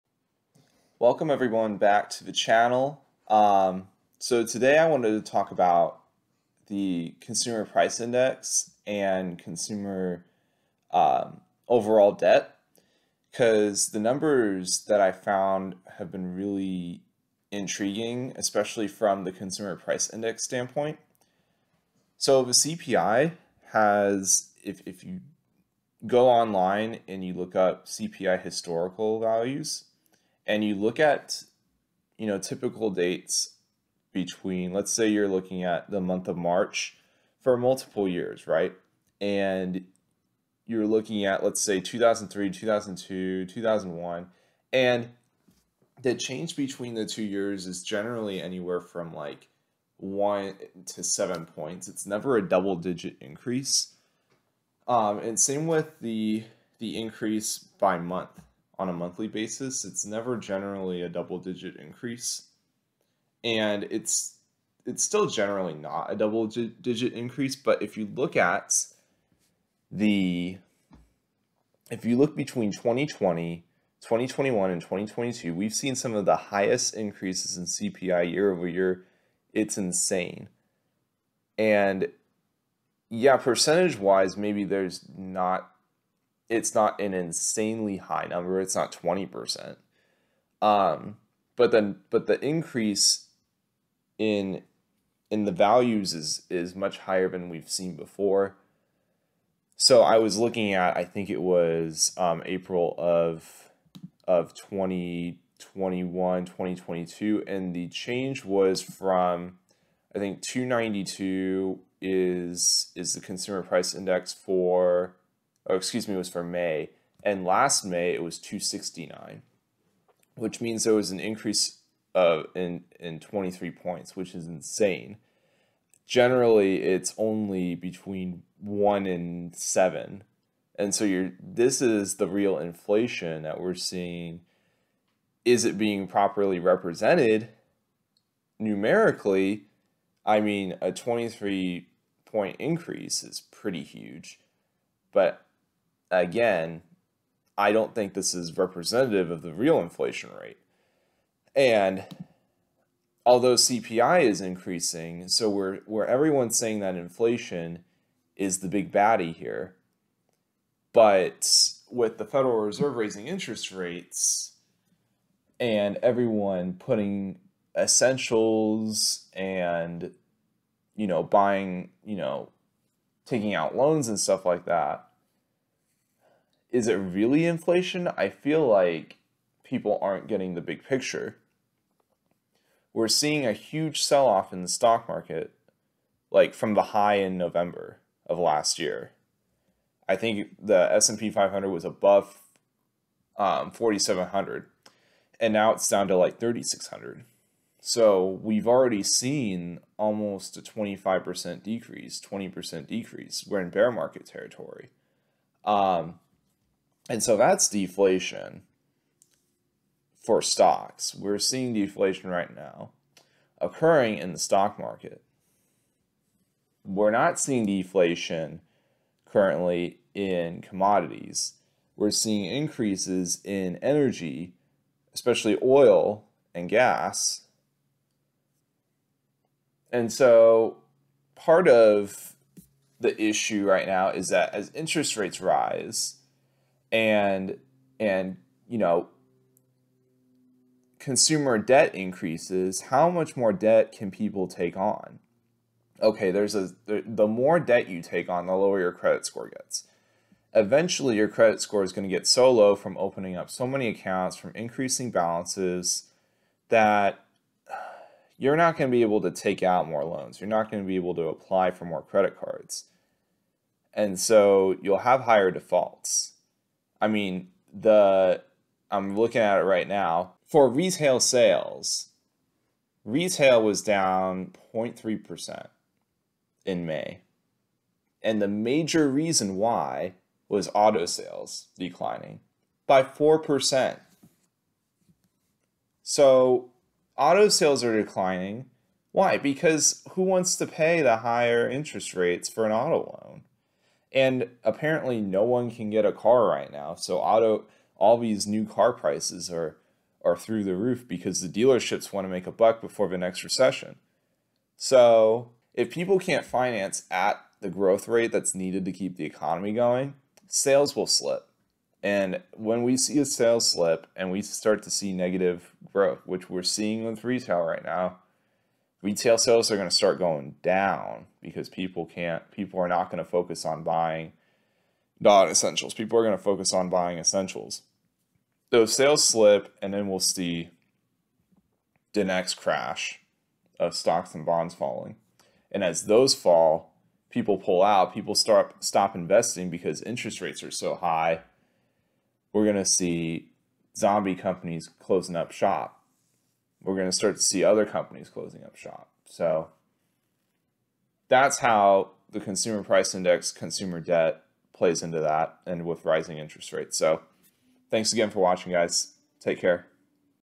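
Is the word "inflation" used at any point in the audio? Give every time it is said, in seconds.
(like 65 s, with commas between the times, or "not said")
132 s, 149 s, 156 s, 177 s.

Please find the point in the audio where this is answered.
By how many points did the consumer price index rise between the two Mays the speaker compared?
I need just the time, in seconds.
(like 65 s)
123 s.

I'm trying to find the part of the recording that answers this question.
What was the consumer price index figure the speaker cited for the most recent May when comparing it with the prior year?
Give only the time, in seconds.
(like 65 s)
110 s.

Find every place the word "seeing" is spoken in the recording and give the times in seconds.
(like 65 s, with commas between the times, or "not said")
133 s, 183 s, 211 s, 217 s, 222 s, 316 s.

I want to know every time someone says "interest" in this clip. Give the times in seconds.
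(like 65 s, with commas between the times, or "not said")
163 s, 234 s, 291 s, 340 s, 356 s.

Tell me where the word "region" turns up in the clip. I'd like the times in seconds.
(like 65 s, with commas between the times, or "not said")
not said.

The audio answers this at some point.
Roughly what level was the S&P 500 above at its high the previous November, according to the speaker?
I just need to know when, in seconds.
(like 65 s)
193 s.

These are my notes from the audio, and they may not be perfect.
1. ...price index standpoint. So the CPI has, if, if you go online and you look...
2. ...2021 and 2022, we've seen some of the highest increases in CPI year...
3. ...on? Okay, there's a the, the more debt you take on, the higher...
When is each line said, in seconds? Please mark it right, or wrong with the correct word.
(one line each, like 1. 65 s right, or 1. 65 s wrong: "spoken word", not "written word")
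1. 19 s right
2. 74 s right
3. 244 s wrong: "lower", not "higher".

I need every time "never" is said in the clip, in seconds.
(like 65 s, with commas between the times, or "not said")
52 s, 60 s.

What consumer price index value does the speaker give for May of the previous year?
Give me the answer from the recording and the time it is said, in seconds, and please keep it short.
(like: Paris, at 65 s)
269, at 118 s.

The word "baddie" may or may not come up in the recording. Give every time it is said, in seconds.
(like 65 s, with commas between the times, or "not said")
158 s.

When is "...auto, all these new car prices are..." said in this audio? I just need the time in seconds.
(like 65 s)
297 s.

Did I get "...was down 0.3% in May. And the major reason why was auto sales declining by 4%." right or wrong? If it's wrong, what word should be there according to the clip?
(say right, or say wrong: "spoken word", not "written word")
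right.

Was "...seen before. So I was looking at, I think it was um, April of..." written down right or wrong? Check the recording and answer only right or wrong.
right.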